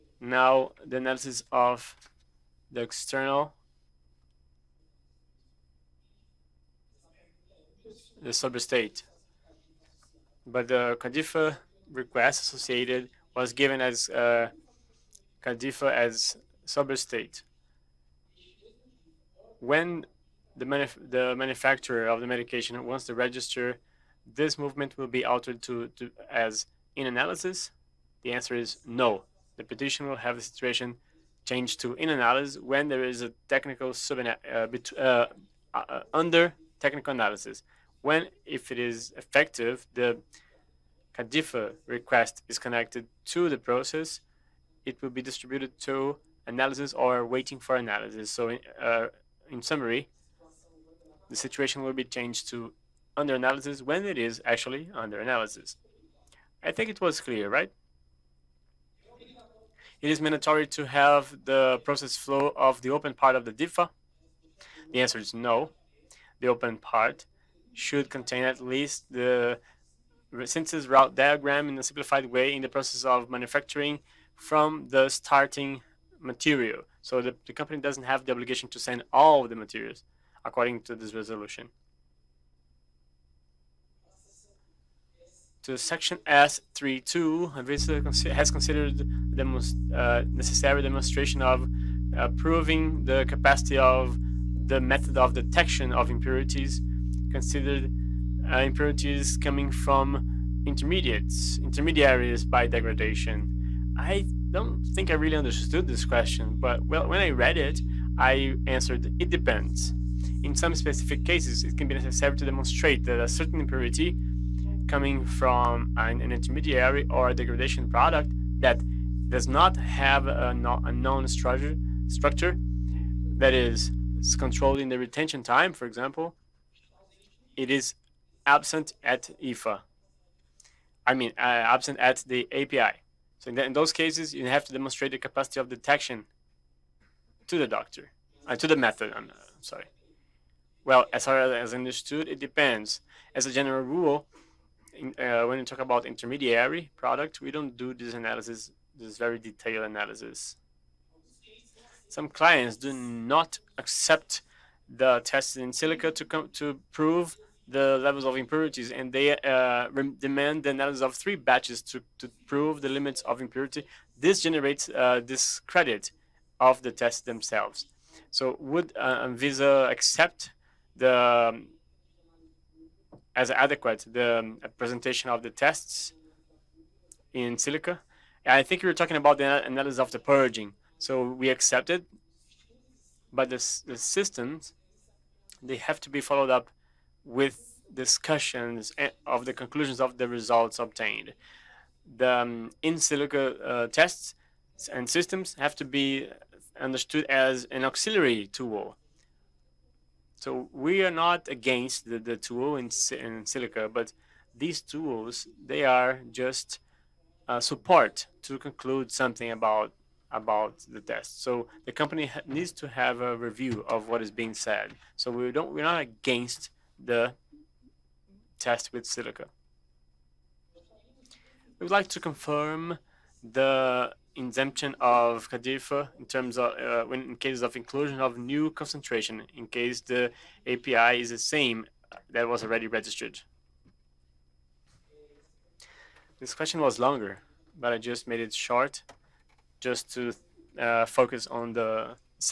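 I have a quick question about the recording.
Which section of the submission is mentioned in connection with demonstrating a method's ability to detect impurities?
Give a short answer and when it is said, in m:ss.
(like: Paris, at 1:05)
S32, at 1:26.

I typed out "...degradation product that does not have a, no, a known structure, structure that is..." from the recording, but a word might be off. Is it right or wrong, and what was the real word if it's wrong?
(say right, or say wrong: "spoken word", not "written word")
right.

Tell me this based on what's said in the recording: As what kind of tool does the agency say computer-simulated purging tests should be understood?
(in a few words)
An auxiliary tool.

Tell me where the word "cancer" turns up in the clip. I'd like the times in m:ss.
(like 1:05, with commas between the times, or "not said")
not said.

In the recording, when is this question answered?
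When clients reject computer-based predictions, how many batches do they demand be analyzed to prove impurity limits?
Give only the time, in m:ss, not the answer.
2:41.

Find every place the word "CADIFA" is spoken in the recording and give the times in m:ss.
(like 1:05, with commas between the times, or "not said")
0:11, 0:41, 3:45.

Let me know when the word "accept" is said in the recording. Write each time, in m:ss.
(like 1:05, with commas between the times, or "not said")
2:33, 2:49, 3:01.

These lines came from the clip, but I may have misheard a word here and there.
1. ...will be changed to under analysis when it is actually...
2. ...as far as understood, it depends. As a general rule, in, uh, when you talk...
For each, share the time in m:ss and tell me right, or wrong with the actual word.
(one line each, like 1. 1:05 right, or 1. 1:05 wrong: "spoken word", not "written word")
1. 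0:51 right
2. 2:21 right.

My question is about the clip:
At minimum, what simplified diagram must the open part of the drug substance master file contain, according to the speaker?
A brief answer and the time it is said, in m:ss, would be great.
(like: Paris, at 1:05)
Synthesis route diagram, at 1:10.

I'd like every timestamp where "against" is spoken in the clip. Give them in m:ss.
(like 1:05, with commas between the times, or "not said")
3:21, 3:36.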